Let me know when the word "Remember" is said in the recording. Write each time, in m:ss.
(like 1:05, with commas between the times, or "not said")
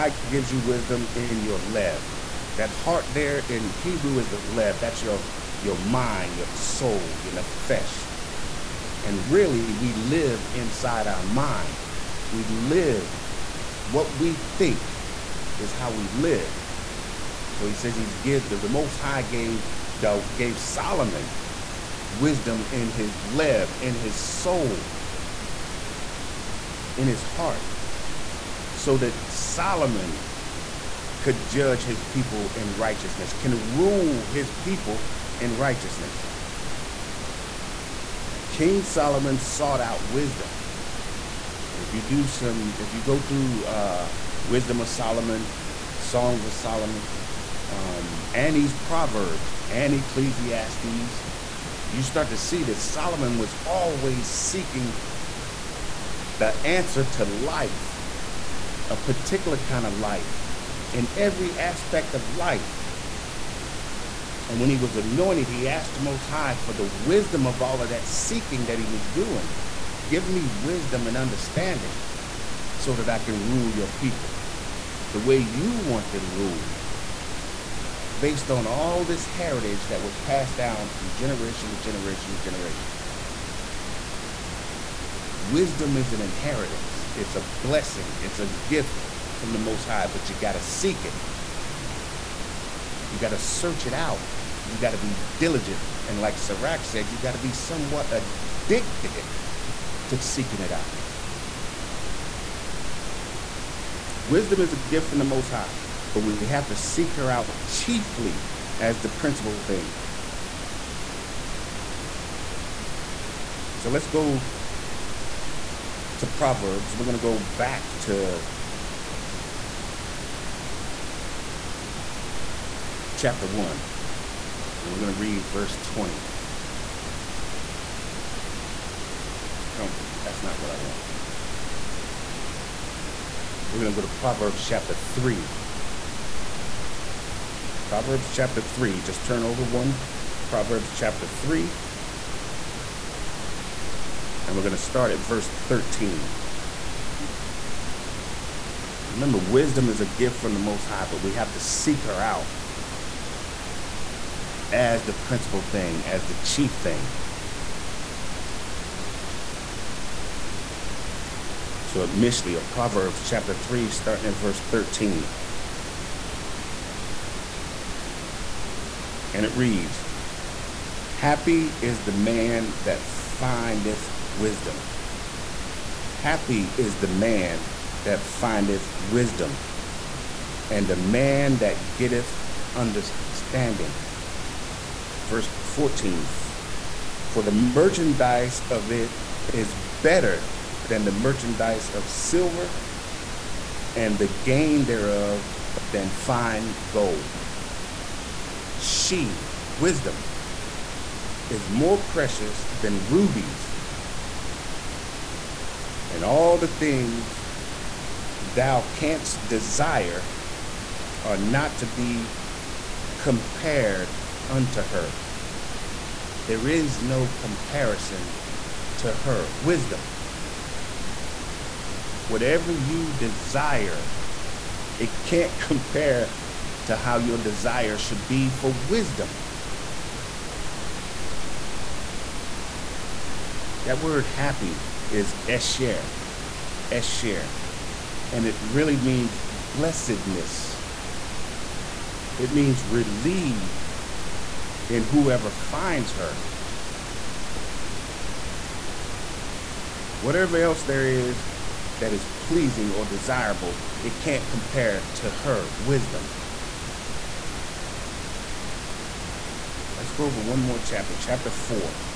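2:29.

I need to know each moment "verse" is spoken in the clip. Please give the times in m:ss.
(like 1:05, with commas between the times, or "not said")
2:05, 2:25, 2:44, 3:05.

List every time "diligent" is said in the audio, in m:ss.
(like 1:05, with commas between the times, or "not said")
1:35.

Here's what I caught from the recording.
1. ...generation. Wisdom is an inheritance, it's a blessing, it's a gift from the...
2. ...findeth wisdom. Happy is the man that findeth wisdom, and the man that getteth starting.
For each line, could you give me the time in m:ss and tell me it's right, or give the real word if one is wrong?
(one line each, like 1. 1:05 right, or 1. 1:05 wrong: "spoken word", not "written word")
1. 1:22 right
2. 2:53 wrong: "understanding", not "starting".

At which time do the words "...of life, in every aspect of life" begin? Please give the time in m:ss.
0:59.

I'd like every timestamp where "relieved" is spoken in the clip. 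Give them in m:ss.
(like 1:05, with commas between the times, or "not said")
4:02.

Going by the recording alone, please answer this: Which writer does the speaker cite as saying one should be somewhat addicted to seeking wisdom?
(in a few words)
Sirach.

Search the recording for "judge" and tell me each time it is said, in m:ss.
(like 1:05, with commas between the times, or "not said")
0:31.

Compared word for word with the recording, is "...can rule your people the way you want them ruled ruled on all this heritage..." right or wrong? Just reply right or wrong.
wrong.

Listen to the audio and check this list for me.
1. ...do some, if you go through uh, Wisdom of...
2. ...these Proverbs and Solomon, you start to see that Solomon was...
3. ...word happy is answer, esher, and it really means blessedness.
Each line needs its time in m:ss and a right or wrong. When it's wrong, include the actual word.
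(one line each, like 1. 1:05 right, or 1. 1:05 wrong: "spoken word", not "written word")
1. 0:42 right
2. 0:48 wrong: "Ecclesiastes", not "Solomon"
3. 3:54 wrong: "esher", not "answer".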